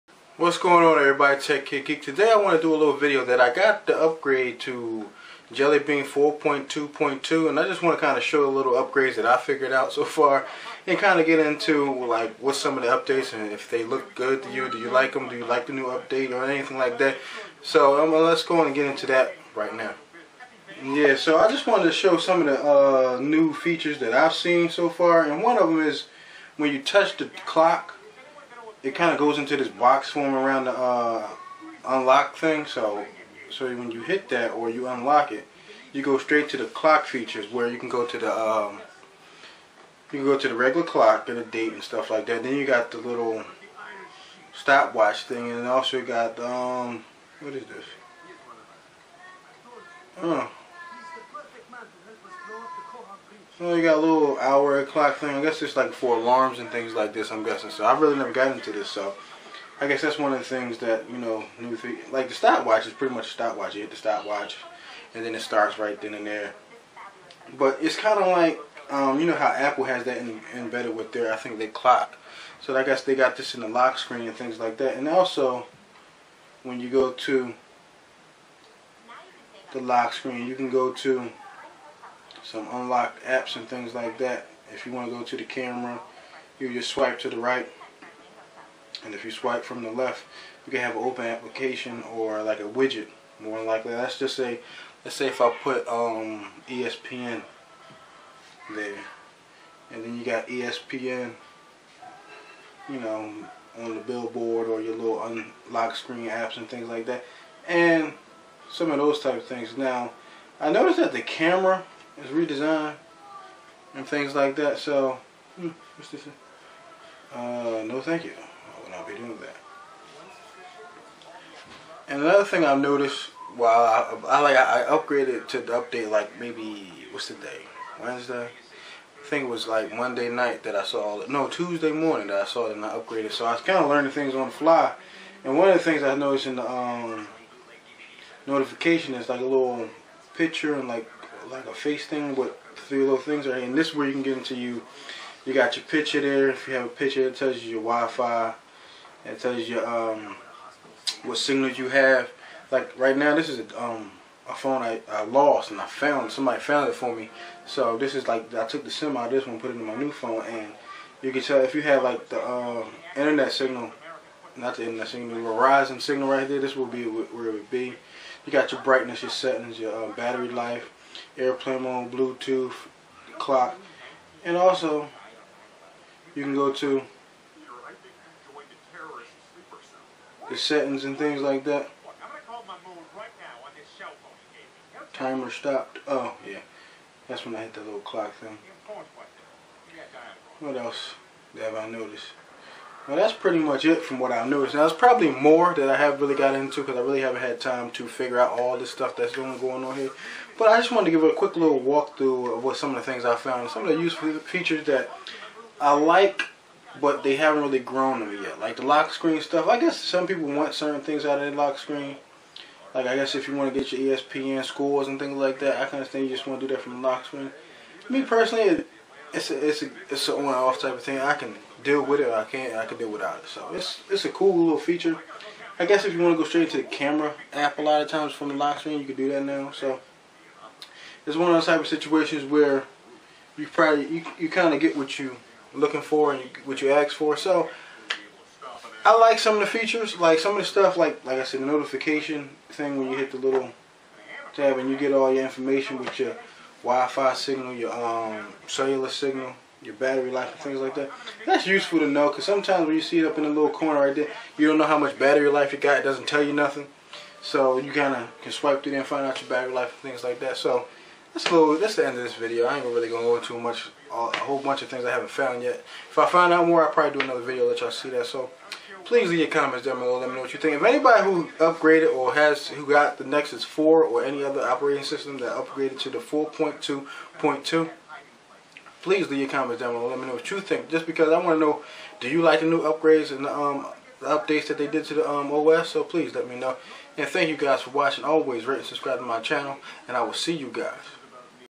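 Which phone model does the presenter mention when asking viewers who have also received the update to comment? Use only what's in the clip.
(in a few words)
Nexus 4.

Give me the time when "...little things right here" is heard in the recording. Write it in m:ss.
2:23.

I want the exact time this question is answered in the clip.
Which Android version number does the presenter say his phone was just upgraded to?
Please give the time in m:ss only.
0:05.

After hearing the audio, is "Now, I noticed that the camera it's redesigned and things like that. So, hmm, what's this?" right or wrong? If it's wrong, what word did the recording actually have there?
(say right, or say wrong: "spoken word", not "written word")
right.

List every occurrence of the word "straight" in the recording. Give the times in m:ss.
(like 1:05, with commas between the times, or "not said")
0:36, 3:46.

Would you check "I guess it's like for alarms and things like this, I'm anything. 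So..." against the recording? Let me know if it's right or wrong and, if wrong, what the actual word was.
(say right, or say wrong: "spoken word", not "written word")
wrong: "guessing", not "anything".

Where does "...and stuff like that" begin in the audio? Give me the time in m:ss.
0:41.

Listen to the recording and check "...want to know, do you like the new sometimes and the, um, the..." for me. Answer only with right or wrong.
wrong.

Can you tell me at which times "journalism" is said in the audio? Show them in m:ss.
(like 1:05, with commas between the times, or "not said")
not said.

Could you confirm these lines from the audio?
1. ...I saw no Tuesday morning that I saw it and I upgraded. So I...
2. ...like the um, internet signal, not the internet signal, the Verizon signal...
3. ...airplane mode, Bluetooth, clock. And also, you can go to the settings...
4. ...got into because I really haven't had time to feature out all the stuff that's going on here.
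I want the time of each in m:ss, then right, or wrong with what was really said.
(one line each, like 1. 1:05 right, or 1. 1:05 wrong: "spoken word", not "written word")
1. 2:10 right
2. 2:42 right
3. 2:51 right
4. 3:16 wrong: "figure", not "feature".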